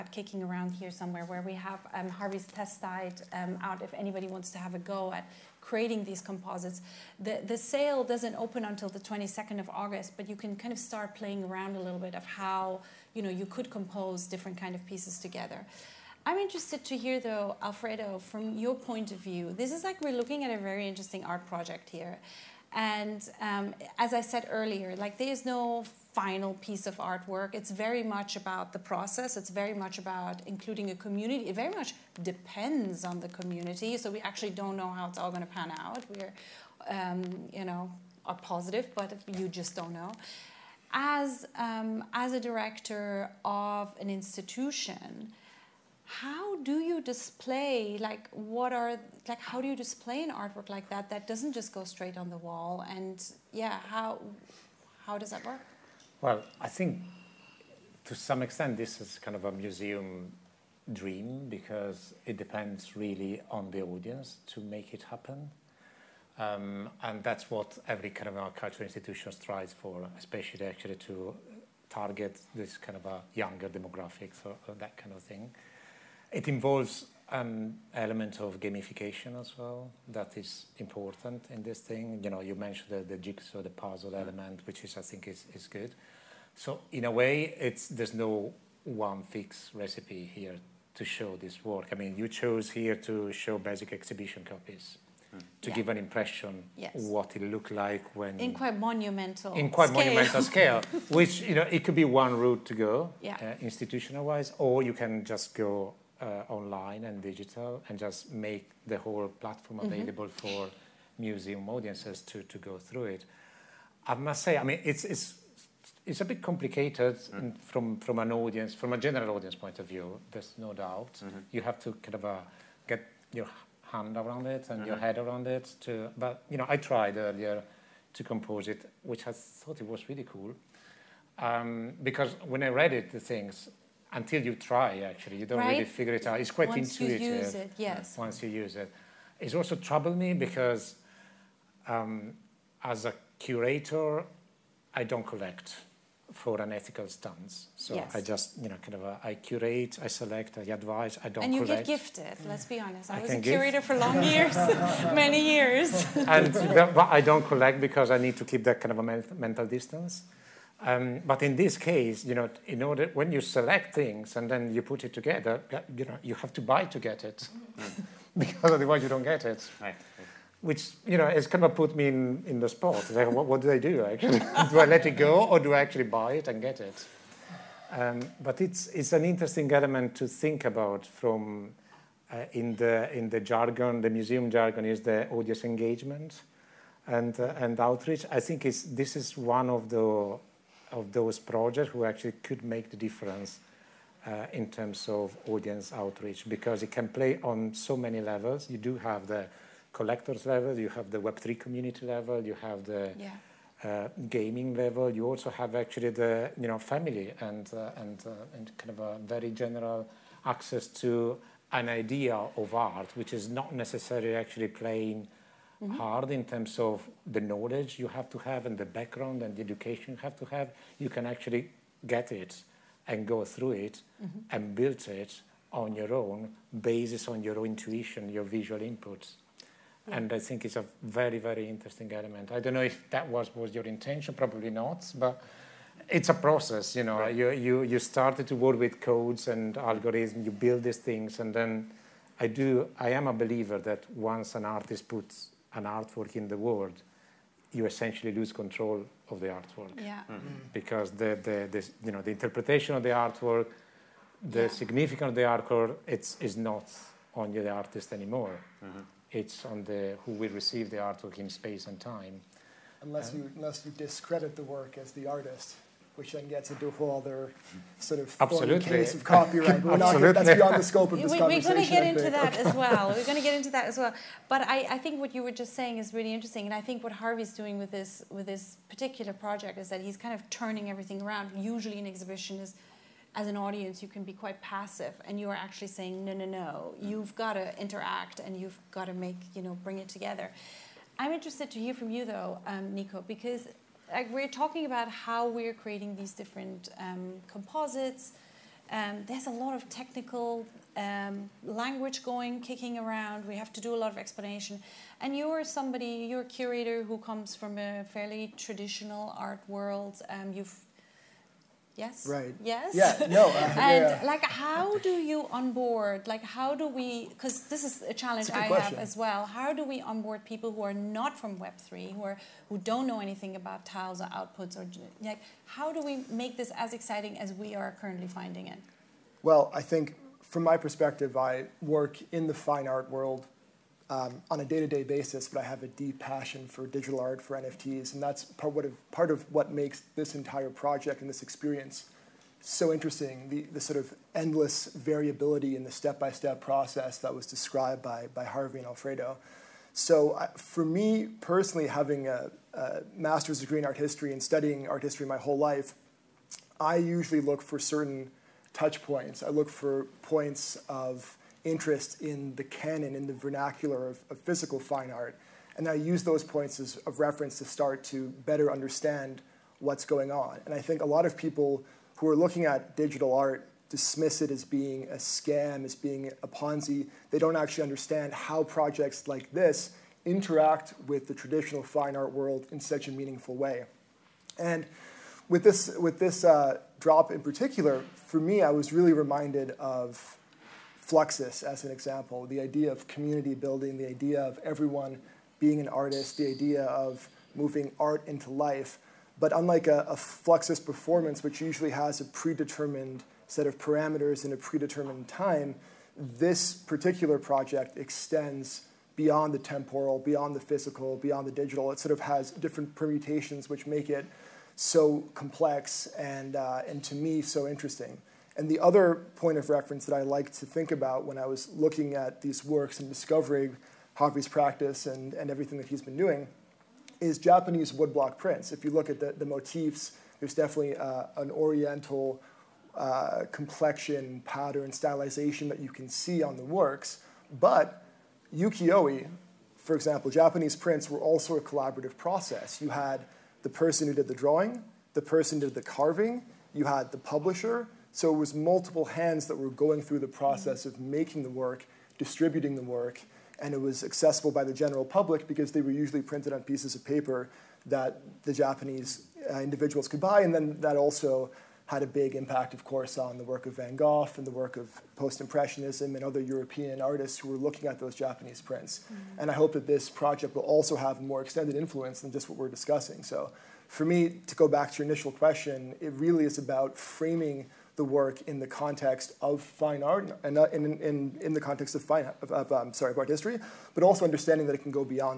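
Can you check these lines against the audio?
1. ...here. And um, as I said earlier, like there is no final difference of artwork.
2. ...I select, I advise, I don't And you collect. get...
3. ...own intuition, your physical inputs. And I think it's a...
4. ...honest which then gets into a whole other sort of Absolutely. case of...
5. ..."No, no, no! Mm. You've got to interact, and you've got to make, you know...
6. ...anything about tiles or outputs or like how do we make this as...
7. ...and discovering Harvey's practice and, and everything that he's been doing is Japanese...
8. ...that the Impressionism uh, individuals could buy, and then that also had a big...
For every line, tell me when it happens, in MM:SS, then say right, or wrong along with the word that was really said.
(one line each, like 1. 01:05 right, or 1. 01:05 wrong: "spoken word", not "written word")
1. 00:21 wrong: "piece", not "difference"
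2. 02:30 right
3. 03:47 wrong: "visual", not "physical"
4. 04:25 wrong: "artist", not "honest"
5. 04:46 right
6. 05:23 right
7. 07:02 right
8. 07:37 wrong: "Japanese", not "Impressionism".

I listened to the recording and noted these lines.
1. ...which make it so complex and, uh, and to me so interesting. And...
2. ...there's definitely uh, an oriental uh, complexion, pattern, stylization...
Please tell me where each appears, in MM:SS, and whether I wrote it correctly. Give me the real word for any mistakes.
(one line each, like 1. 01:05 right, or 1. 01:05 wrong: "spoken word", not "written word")
1. 06:53 right
2. 07:10 right.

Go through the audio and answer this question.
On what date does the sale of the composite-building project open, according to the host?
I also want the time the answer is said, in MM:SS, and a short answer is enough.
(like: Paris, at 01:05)
22nd of August, at 00:08.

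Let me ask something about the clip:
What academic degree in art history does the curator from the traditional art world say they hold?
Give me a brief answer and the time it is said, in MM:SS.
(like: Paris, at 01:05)
master's degree, at 05:53.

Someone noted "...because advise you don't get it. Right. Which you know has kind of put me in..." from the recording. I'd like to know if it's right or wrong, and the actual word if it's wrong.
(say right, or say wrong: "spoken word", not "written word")
wrong: "otherwise", not "advise".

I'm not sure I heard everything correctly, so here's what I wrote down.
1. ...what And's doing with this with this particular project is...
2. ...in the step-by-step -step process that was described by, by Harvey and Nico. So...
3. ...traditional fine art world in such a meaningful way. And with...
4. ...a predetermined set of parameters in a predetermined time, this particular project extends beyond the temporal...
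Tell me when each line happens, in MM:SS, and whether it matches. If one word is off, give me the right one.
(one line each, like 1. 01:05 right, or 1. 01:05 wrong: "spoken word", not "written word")
1. 04:37 wrong: "Harvey", not "And"
2. 05:45 wrong: "Alfredo", not "Nico"
3. 06:21 right
4. 06:42 right.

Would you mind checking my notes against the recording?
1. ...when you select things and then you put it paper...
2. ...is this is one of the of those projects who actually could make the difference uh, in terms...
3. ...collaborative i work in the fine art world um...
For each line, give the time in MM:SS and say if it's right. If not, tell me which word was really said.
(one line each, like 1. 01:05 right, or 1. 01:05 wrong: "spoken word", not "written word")
1. 02:43 wrong: "together", not "paper"
2. 03:08 right
3. 05:30 wrong: "perspective", not "collaborative".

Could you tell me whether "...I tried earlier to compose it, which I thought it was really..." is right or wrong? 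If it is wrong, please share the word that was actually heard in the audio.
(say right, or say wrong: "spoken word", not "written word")
right.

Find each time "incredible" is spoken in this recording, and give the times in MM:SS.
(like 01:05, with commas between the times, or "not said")
not said.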